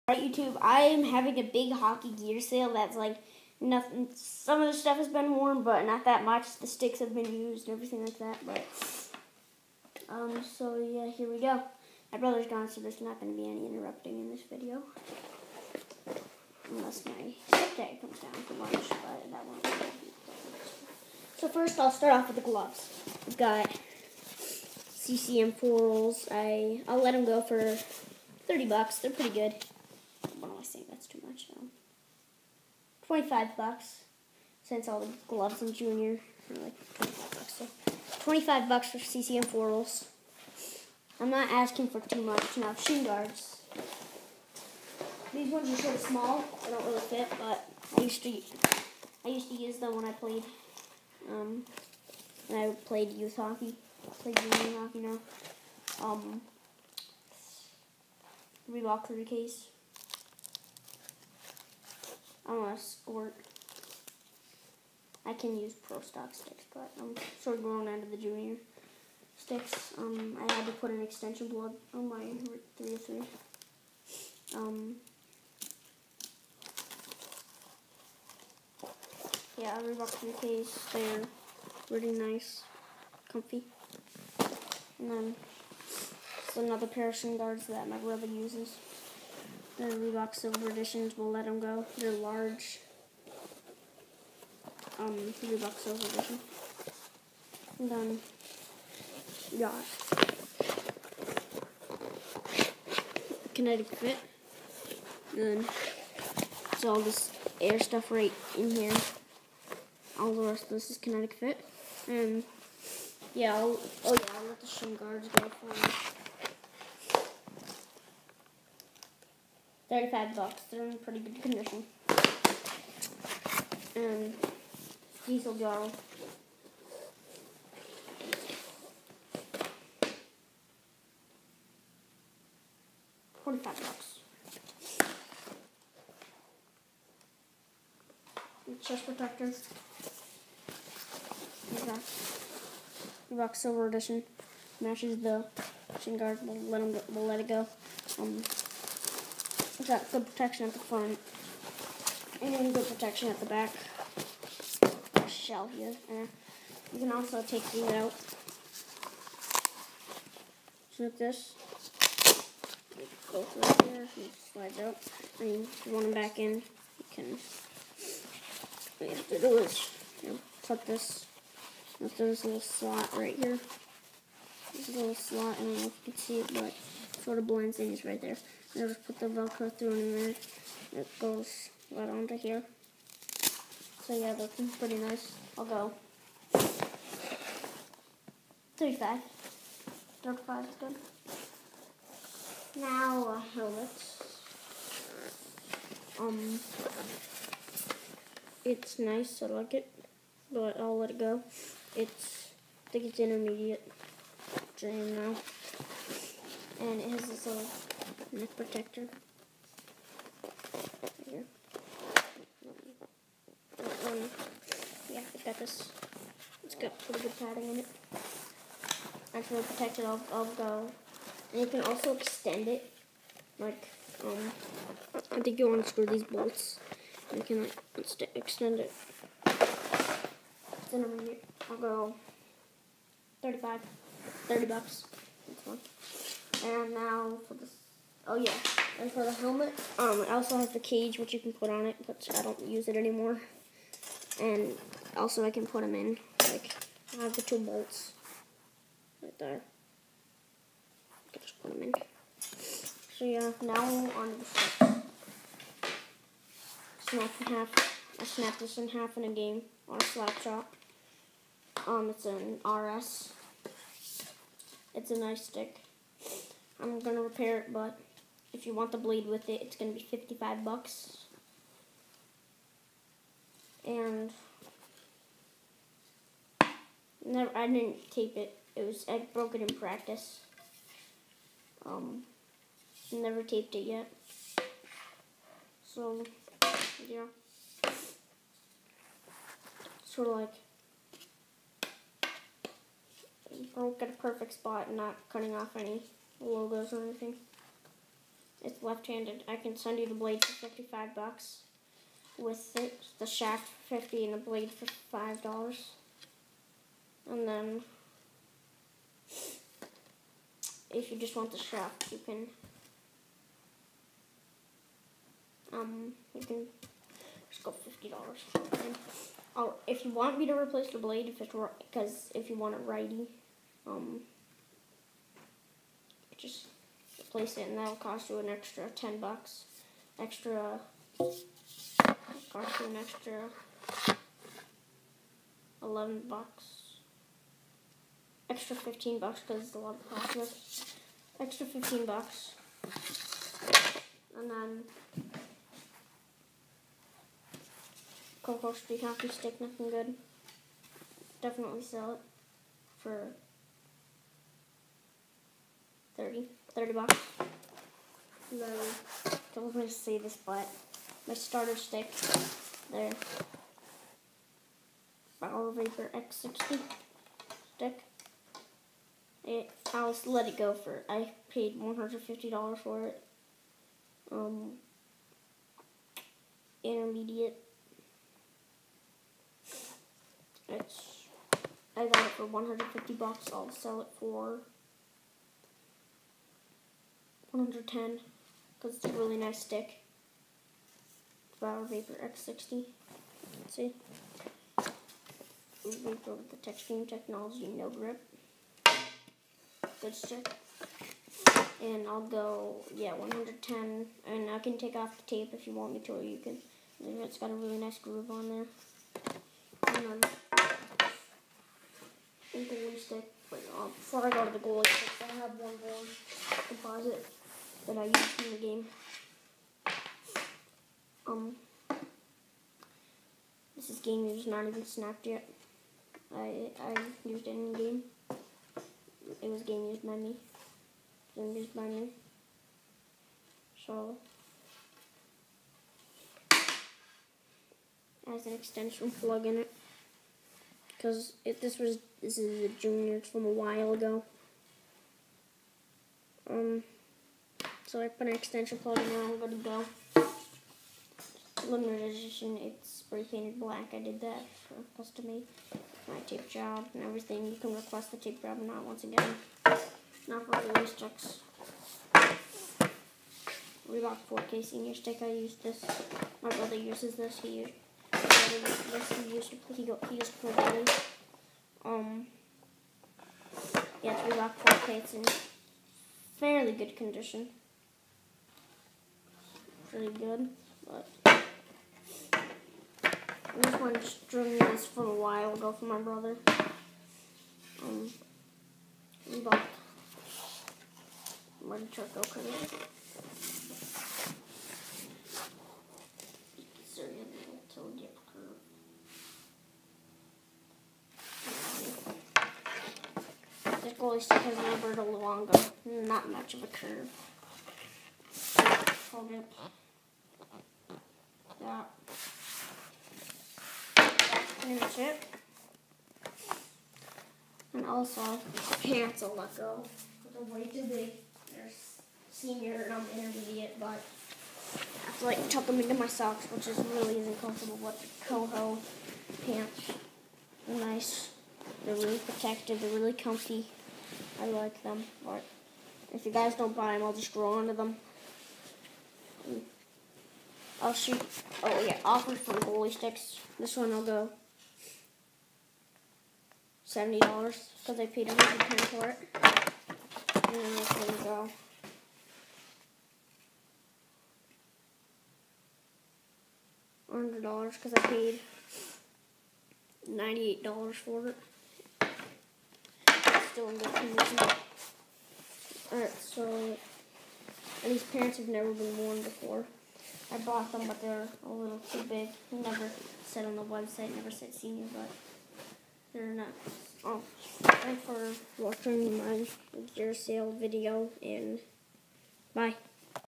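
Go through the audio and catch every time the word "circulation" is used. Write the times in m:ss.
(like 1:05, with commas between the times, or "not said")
not said.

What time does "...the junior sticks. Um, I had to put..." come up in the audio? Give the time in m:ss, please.
1:08.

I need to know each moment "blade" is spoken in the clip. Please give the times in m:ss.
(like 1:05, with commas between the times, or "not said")
4:28, 5:00, 5:04, 5:20.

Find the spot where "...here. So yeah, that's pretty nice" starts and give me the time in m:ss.
3:02.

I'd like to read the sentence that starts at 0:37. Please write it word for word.
So 25 bucks for CCM four rolls.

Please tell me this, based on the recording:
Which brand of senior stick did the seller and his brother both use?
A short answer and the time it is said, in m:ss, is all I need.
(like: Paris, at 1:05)
Reebok 4K, at 7:43.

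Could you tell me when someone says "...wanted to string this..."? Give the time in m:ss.
8:03.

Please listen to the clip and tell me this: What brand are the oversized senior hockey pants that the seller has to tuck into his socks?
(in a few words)
Koho.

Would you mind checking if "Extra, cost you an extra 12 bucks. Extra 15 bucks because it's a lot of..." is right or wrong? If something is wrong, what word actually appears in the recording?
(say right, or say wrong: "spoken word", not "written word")
wrong: "11", not "12".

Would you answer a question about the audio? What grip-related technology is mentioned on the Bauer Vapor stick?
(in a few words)
Textreme Technology.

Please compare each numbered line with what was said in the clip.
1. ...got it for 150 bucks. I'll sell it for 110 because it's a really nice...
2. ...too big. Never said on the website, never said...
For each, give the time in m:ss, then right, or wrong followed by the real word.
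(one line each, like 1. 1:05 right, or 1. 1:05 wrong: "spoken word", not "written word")
1. 6:22 right
2. 9:31 right.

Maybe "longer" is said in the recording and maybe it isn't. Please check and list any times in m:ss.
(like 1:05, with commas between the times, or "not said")
8:25.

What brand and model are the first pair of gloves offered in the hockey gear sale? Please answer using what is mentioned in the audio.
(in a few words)
CCM foils.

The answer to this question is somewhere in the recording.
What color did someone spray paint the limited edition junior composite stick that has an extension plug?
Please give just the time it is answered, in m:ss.
7:32.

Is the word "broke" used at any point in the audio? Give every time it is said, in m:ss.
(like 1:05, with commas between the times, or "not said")
4:39, 4:53.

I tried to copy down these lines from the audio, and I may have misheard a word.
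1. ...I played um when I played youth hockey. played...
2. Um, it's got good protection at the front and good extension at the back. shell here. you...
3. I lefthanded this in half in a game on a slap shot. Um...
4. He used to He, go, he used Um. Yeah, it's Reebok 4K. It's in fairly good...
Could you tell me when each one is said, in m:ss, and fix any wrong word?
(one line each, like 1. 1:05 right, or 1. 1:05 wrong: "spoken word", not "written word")
1. 0:50 right
2. 2:28 wrong: "protection", not "extension"
3. 4:18 wrong: "snapped", not "lefthanded"
4. 7:49 right.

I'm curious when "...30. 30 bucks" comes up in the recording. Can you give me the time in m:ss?
5:56.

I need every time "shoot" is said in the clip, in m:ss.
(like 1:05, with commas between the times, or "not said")
9:00.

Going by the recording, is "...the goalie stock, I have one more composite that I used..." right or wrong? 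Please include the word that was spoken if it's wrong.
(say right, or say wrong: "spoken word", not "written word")
wrong: "stick", not "stock".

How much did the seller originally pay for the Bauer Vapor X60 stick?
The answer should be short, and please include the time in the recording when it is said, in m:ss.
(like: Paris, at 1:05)
$150, at 6:11.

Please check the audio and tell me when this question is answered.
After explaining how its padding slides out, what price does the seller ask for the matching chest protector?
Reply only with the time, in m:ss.
3:08.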